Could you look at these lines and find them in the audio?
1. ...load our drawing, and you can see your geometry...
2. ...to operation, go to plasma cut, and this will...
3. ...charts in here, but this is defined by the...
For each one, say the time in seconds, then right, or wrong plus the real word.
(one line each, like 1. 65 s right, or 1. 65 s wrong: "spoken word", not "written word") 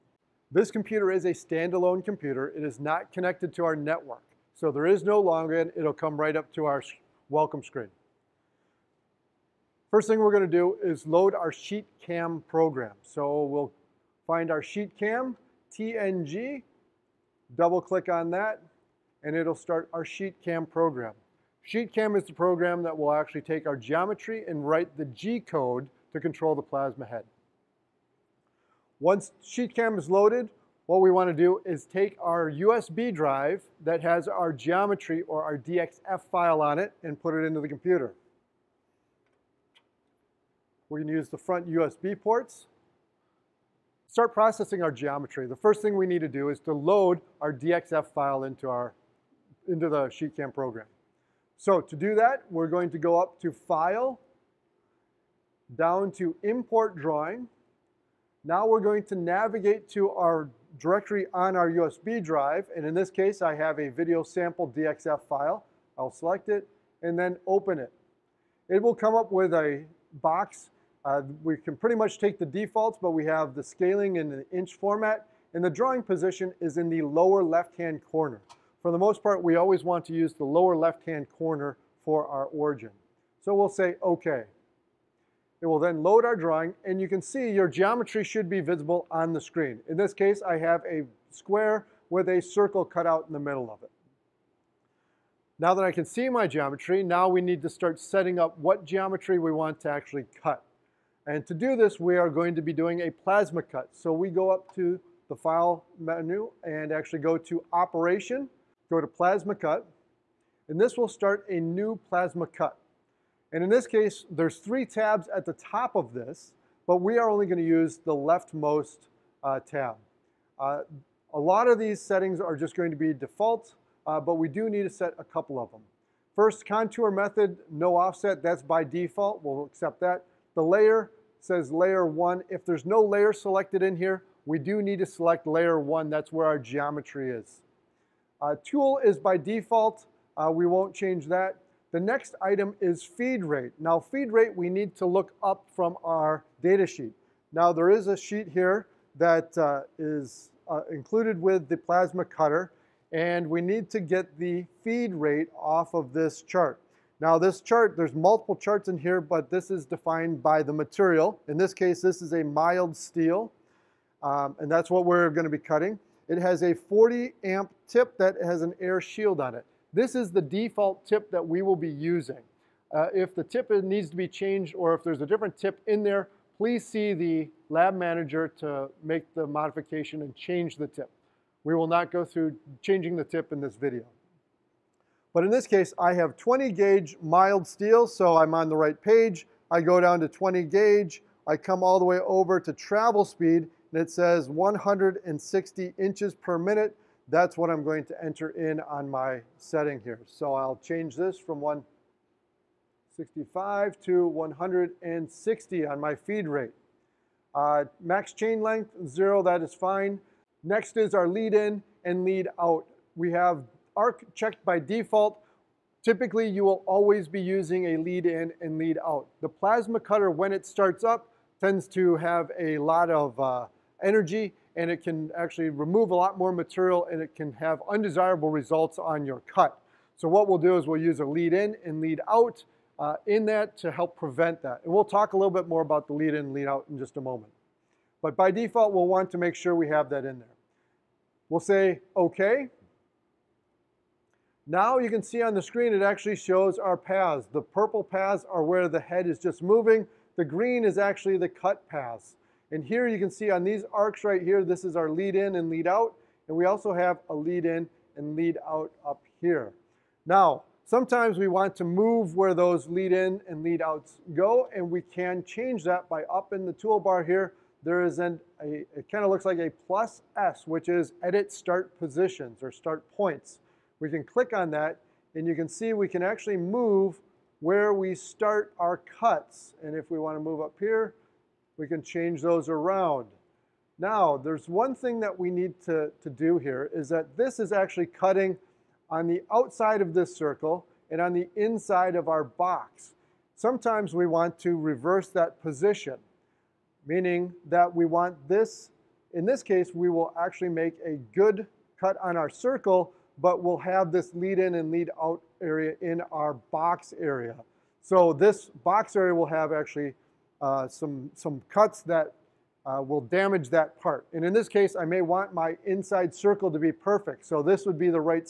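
1. 86 s right
2. 107 s right
3. 158 s right.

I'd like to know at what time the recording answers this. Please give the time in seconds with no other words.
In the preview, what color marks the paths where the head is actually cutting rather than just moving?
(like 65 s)
250 s.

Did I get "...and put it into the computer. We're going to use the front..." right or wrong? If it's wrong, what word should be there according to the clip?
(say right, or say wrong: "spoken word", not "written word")
right.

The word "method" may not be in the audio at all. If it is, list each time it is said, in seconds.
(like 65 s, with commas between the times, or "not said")
127 s.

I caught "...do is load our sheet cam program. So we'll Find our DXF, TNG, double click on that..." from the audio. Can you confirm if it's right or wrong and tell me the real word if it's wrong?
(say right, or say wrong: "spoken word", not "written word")
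wrong: "SheetCam", not "DXF".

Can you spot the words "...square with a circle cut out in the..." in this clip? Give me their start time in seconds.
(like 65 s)
91 s.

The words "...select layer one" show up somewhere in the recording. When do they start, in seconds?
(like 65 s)
135 s.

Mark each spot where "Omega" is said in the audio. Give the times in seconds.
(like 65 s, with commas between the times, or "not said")
not said.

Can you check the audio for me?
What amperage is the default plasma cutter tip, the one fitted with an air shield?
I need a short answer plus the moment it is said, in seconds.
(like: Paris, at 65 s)
40 amp, at 166 s.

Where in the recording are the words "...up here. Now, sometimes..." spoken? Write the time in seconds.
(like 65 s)
259 s.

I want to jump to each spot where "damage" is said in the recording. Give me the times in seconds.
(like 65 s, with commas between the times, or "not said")
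313 s.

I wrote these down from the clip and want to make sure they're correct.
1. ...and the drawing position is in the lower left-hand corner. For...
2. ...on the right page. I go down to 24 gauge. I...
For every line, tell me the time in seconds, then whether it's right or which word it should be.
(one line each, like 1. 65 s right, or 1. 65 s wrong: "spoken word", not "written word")
1. 75 s right
2. 188 s wrong: "20", not "24".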